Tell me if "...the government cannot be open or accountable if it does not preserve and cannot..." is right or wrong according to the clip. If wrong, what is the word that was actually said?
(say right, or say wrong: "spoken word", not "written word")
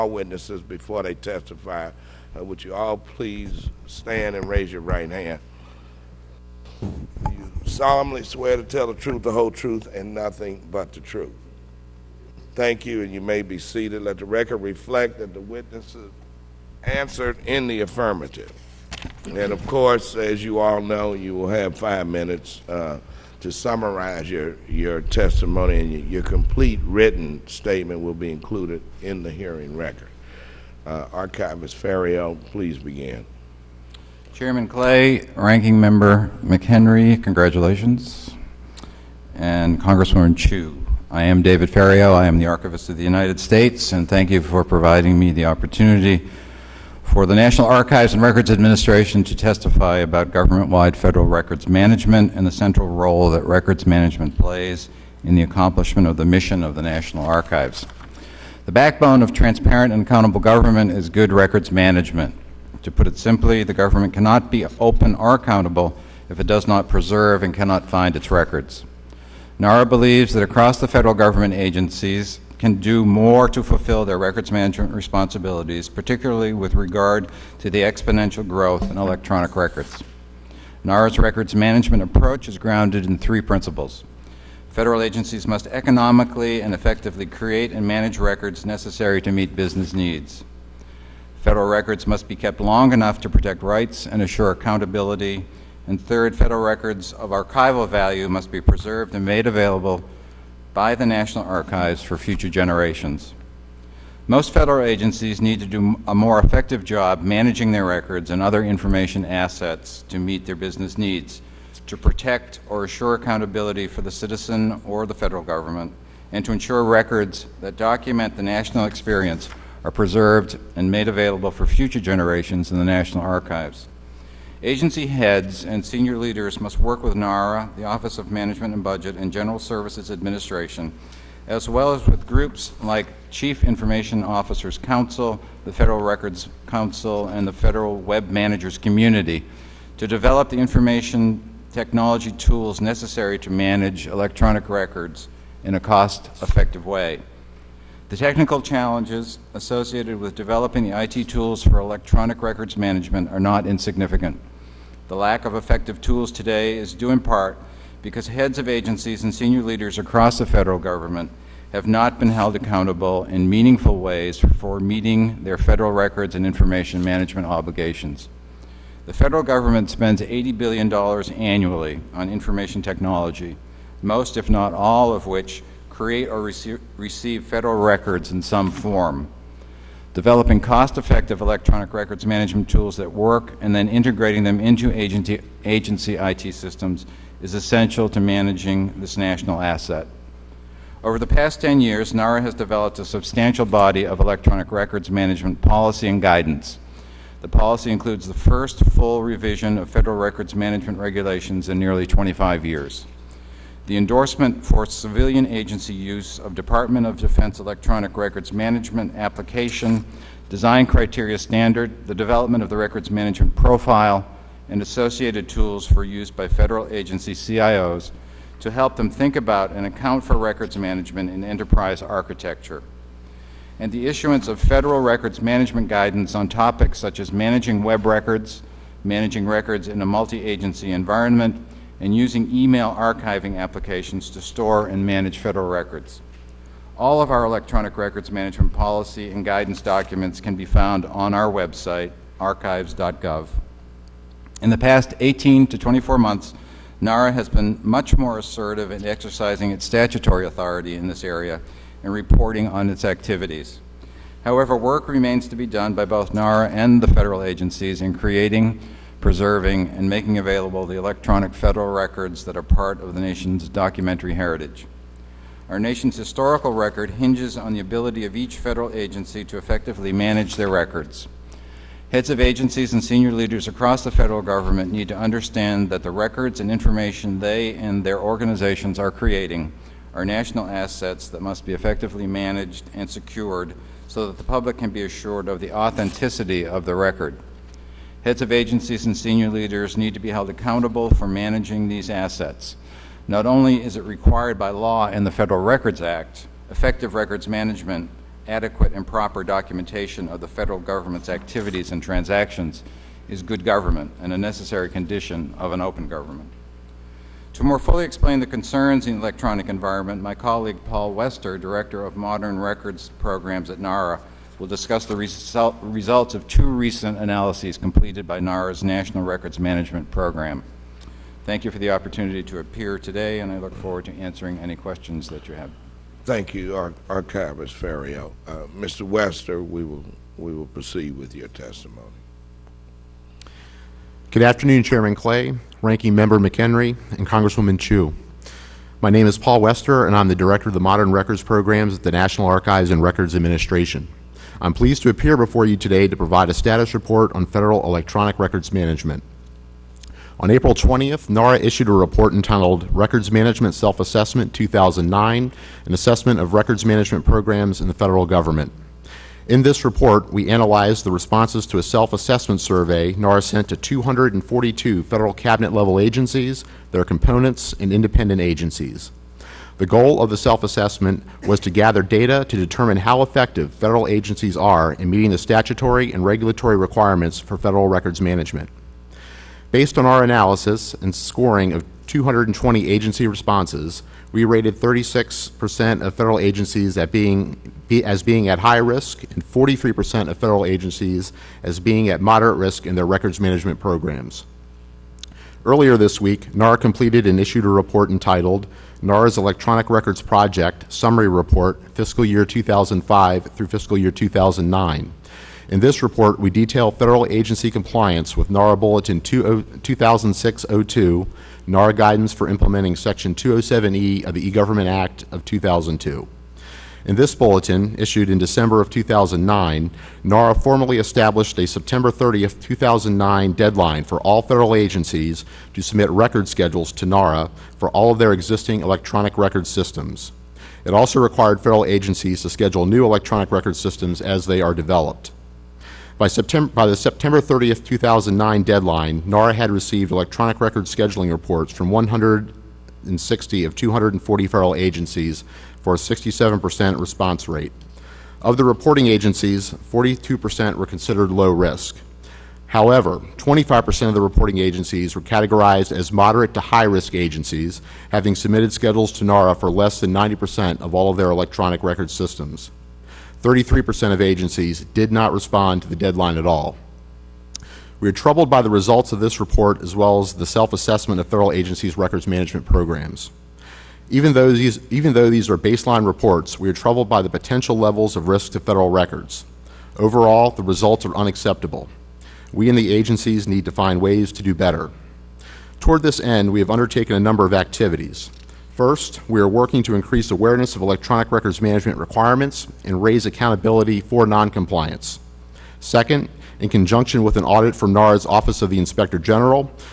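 right.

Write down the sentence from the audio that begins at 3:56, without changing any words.
All of our electronic records management policy and guidance documents can be found on our website, archives.gov.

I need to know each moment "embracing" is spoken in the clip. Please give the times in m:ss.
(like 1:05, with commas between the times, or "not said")
not said.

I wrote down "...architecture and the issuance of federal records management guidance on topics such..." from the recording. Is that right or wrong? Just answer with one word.
right.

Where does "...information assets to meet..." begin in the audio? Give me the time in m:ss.
1:48.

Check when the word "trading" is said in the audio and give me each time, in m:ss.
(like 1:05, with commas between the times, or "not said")
not said.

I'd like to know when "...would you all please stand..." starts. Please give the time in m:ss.
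0:02.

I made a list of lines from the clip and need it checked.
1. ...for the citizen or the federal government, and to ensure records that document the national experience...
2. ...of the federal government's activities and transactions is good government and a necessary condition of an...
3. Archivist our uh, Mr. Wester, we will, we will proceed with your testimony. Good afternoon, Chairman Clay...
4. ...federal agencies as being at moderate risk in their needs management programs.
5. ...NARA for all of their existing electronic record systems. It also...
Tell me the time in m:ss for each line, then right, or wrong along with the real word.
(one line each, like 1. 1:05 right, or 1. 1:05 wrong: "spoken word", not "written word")
1. 1:53 right
2. 5:00 right
3. 5:27 right
4. 6:30 wrong: "records", not "needs"
5. 7:07 right.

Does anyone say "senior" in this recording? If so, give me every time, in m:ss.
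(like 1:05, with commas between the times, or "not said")
2:05, 2:39, 4:33, 4:49.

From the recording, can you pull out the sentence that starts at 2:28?
The technical challenges associated with developing the IT tools for electronic records management are not insignificant.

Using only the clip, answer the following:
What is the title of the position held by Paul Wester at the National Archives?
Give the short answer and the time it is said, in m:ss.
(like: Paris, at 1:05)
Director of Modern Records Programs, at 5:11.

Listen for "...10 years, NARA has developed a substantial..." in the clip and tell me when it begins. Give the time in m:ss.
3:11.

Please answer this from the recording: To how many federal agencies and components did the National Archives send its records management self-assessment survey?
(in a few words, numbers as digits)
242.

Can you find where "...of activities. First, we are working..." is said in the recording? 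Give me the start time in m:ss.
8:07.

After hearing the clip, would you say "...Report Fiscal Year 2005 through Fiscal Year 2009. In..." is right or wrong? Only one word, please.
right.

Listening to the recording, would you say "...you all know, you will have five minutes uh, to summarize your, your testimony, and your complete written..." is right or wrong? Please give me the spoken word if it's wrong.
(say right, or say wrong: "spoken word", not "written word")
right.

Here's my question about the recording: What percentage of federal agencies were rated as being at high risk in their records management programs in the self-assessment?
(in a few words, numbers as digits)
36%.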